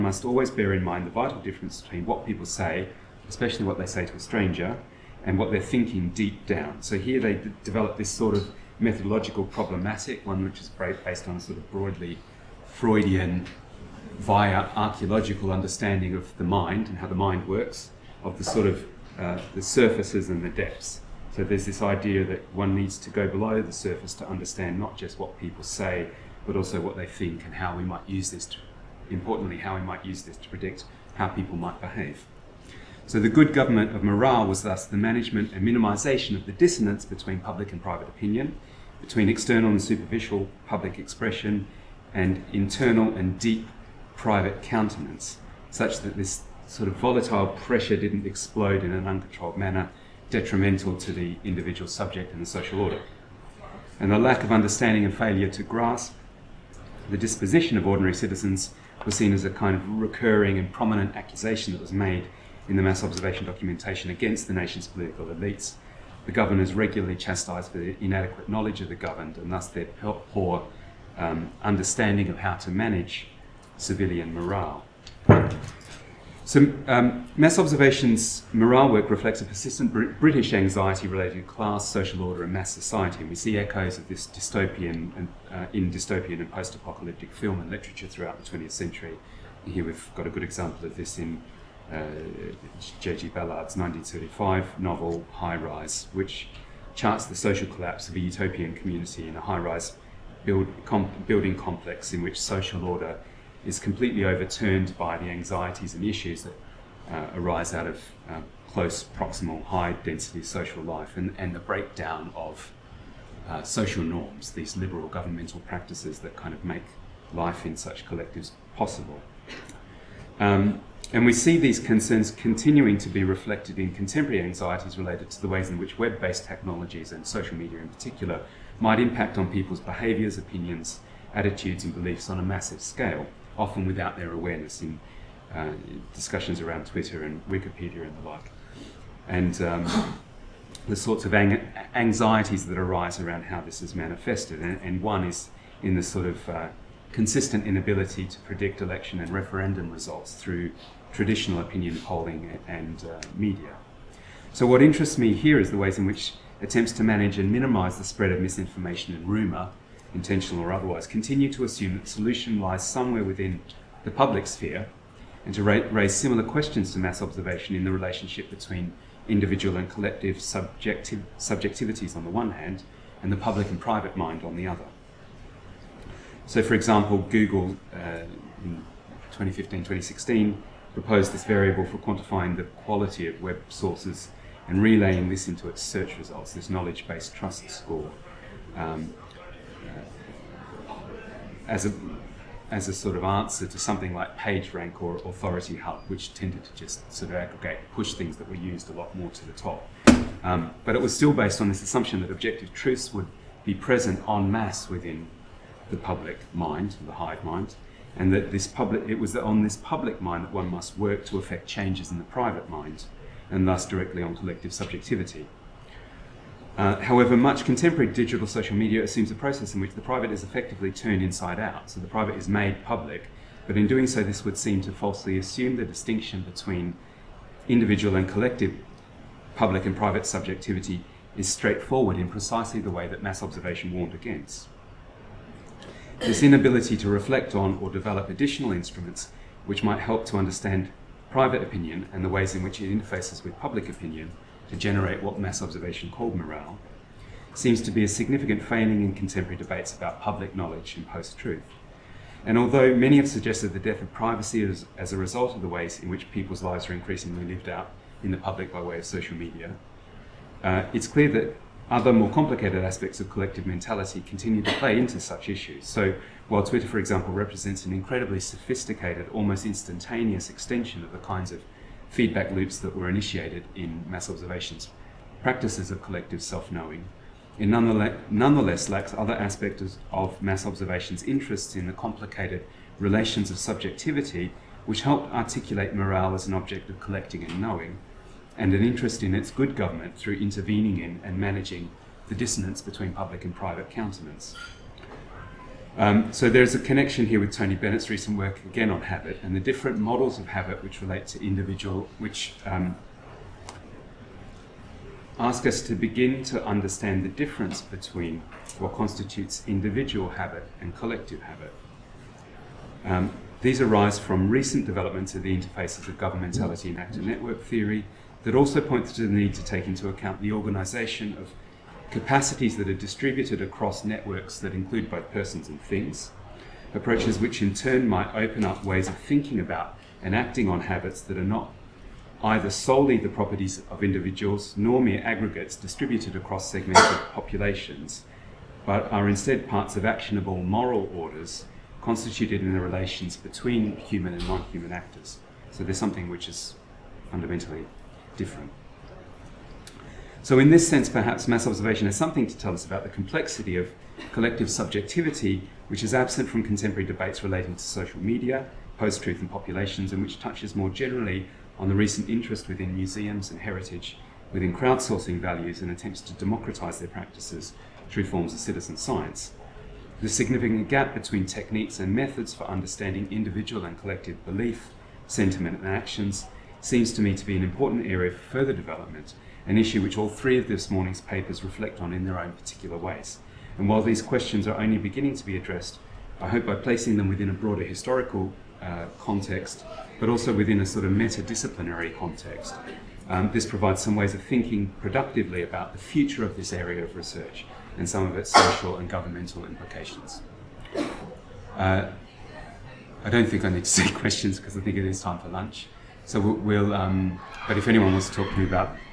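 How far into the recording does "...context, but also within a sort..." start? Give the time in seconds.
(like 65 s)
389 s.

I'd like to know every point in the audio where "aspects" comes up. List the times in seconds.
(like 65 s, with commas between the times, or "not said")
262 s, 279 s.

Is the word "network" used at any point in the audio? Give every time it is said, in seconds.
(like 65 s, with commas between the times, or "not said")
317 s, 324 s.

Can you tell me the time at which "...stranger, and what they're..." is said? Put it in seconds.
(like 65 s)
4 s.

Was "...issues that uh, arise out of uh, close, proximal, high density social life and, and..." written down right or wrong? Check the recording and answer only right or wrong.
right.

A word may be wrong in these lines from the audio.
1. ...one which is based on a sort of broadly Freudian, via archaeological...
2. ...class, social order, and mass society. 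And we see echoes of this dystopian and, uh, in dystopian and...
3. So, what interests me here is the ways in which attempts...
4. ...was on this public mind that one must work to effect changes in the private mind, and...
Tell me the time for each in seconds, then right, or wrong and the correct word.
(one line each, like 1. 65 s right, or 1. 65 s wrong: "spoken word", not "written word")
1. 10 s right
2. 81 s right
3. 154 s right
4. 209 s right.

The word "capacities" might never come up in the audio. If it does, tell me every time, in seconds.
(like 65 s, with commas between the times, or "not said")
322 s.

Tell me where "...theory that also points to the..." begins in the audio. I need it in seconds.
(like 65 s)
317 s.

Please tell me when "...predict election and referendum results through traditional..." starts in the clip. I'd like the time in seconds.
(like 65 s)
148 s.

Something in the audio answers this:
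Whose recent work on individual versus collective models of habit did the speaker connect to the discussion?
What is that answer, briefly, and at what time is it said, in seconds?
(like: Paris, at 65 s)
Tony Bennett, at 297 s.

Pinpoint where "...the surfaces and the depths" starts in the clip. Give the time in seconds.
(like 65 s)
19 s.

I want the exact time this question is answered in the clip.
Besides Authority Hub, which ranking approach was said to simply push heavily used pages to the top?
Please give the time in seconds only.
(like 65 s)
194 s.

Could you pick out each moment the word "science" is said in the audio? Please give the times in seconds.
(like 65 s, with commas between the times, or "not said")
368 s.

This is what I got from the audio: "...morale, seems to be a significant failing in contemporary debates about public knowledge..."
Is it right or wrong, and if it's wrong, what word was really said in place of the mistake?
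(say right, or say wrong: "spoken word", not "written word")
right.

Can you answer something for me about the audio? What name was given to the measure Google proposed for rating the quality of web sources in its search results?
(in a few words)
knowledge-based trust score.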